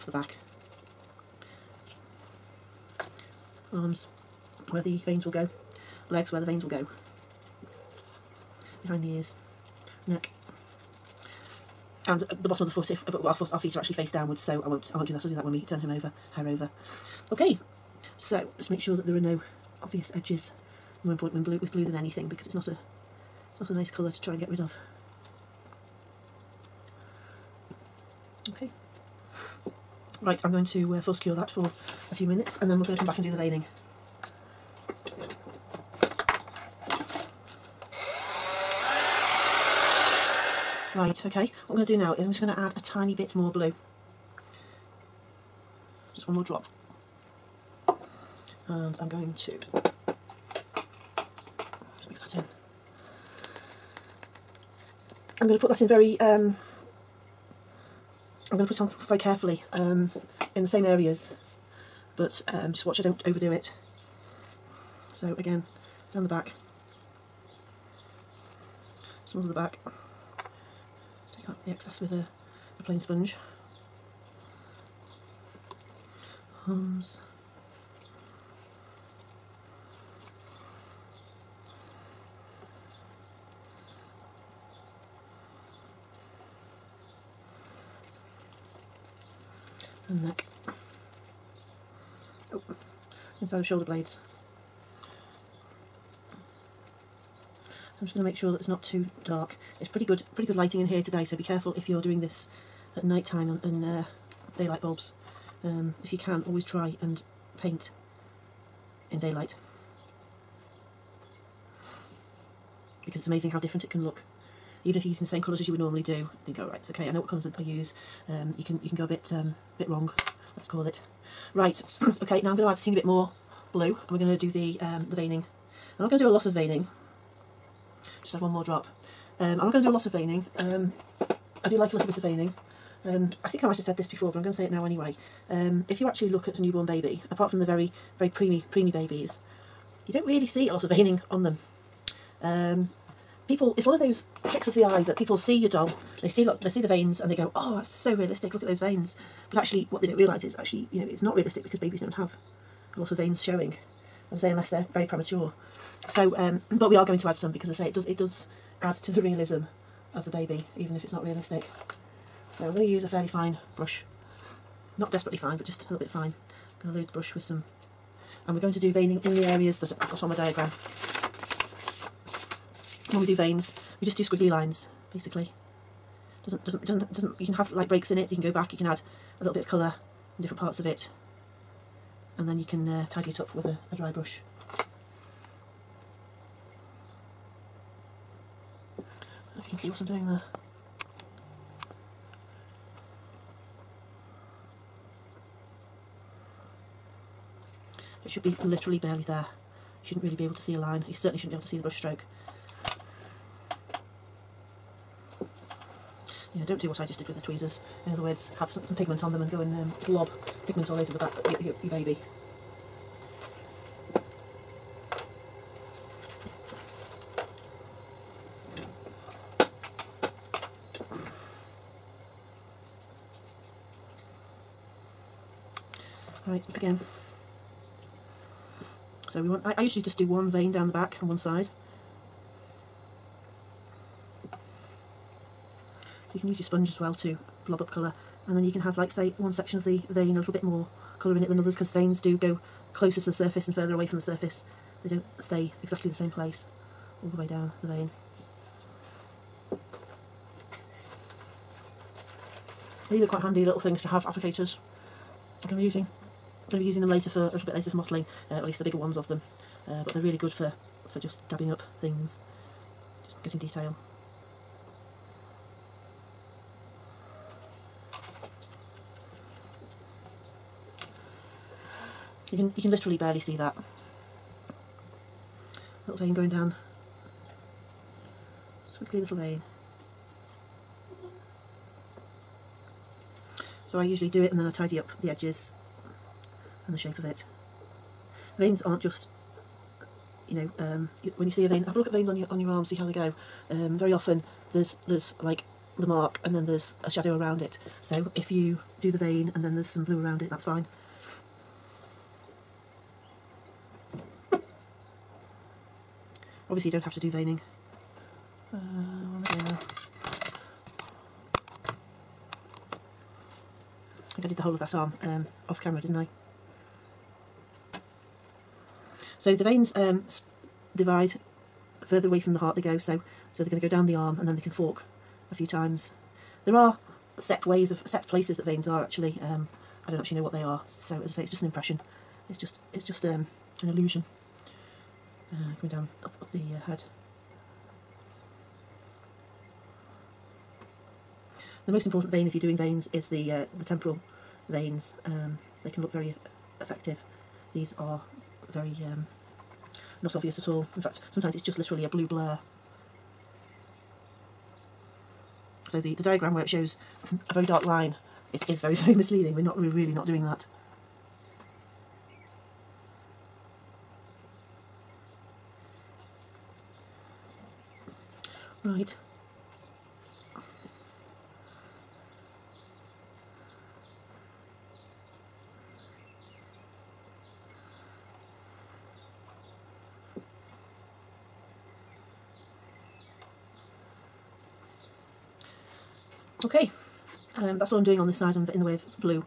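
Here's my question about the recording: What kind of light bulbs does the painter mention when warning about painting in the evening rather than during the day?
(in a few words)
daylight bulbs.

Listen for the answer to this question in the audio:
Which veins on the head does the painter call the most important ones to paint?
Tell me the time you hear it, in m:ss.
5:43.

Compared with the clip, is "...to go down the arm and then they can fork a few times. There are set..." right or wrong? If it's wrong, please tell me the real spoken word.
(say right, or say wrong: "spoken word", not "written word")
right.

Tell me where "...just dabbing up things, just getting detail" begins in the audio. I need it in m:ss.
4:21.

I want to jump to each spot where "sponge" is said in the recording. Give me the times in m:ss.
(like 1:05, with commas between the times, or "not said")
1:12, 3:56.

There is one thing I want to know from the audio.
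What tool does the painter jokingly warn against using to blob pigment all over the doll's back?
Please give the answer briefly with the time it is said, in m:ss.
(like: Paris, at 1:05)
tweezers, at 3:27.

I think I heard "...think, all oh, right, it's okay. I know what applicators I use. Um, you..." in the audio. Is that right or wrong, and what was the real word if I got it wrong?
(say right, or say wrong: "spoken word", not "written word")
wrong: "colours", not "applicators".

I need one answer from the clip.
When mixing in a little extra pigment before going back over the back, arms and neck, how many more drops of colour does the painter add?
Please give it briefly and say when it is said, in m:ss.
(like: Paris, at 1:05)
1, at 0:46.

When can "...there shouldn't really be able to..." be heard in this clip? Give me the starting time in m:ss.
3:19.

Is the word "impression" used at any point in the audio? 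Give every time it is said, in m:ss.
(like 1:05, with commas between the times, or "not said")
5:31.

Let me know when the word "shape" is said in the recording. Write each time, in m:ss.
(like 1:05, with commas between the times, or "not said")
4:46.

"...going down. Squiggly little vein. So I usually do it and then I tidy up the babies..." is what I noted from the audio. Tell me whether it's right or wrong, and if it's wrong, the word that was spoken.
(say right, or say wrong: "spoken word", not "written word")
wrong: "edges", not "babies".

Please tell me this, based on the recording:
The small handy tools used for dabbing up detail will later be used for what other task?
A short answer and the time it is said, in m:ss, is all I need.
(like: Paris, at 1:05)
modelling, at 4:17.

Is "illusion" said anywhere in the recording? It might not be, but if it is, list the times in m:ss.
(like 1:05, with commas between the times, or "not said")
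5:33.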